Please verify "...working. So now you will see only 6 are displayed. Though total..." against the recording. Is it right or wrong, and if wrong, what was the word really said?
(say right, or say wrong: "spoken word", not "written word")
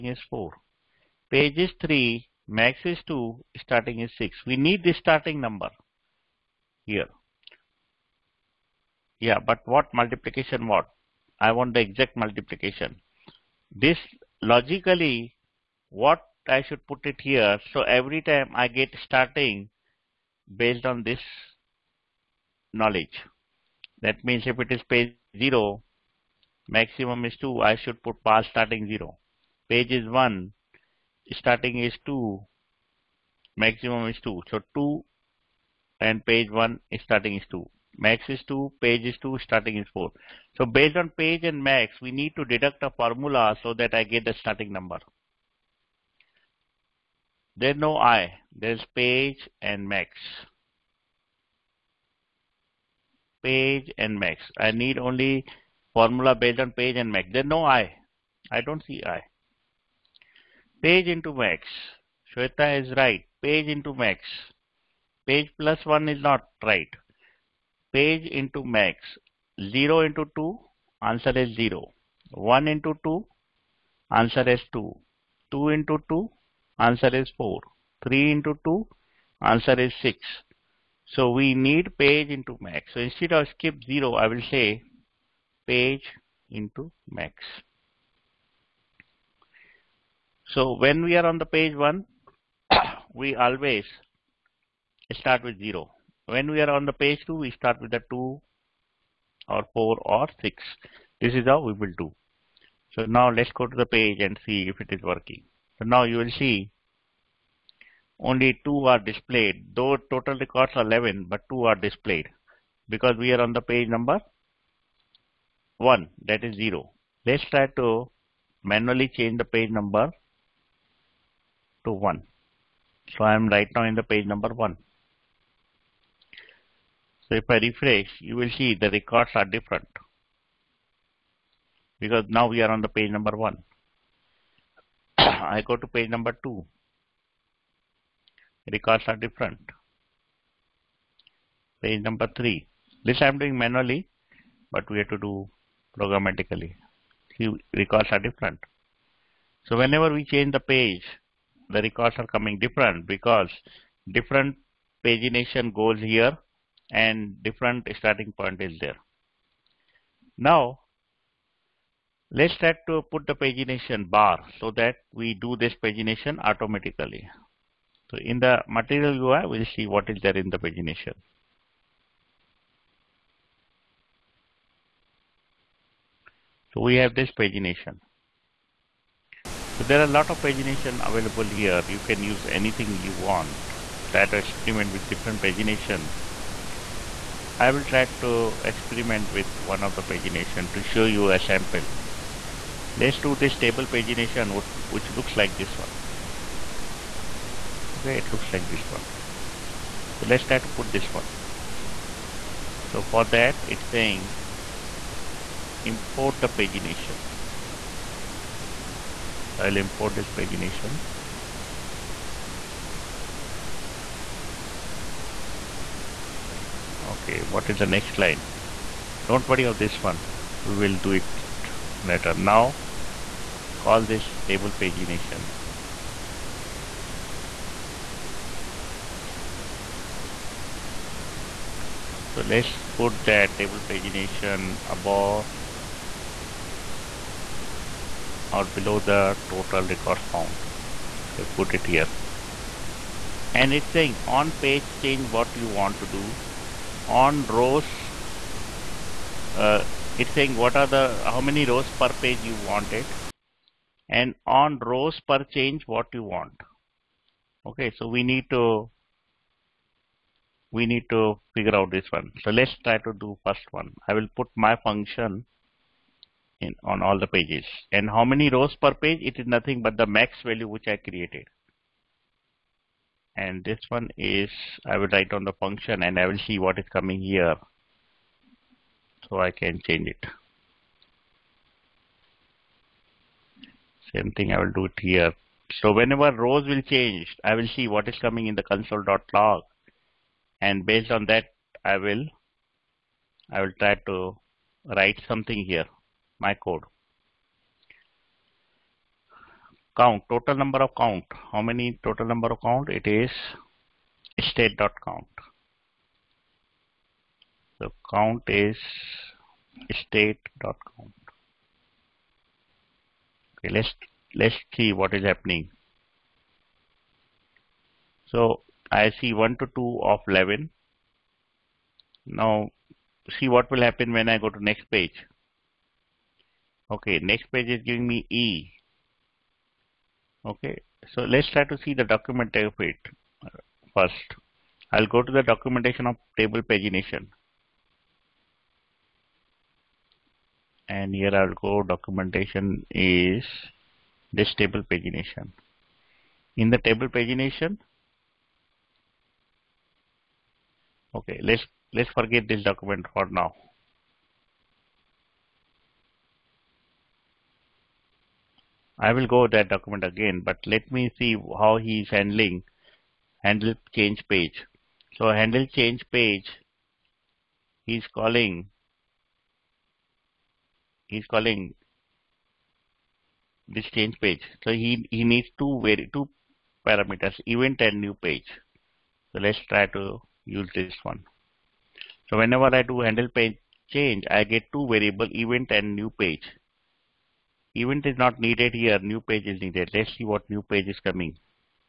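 wrong: "2", not "6".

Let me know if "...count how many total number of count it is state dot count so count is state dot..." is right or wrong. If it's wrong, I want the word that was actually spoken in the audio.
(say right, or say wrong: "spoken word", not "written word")
right.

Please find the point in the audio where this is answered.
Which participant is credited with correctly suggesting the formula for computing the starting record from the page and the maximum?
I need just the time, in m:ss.
1:02.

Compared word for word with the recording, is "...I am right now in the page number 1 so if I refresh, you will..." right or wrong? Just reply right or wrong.
right.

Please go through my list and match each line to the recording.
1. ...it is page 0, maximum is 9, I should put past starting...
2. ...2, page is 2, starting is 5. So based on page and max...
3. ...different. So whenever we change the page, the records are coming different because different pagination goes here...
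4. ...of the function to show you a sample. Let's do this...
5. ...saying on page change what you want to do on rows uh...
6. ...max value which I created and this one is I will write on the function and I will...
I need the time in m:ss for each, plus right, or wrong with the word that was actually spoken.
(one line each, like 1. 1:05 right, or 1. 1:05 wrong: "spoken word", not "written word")
1. 0:24 wrong: "2", not "9"
2. 0:38 wrong: "4", not "5"
3. 2:28 right
4. 3:09 wrong: "pagination", not "function"
5. 4:03 right
6. 4:30 right.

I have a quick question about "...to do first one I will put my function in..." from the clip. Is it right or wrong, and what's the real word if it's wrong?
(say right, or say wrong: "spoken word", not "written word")
right.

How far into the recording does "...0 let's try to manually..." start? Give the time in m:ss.
1:56.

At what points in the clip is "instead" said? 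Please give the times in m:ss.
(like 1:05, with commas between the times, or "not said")
1:23.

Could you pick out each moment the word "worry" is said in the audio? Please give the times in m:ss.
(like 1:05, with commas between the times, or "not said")
3:39.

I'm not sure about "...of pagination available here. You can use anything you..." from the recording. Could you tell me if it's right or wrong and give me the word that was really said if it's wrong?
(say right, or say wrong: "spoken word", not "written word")
right.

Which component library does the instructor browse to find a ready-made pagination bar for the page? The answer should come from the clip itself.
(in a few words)
Material UI.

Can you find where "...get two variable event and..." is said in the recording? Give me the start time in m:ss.
6:24.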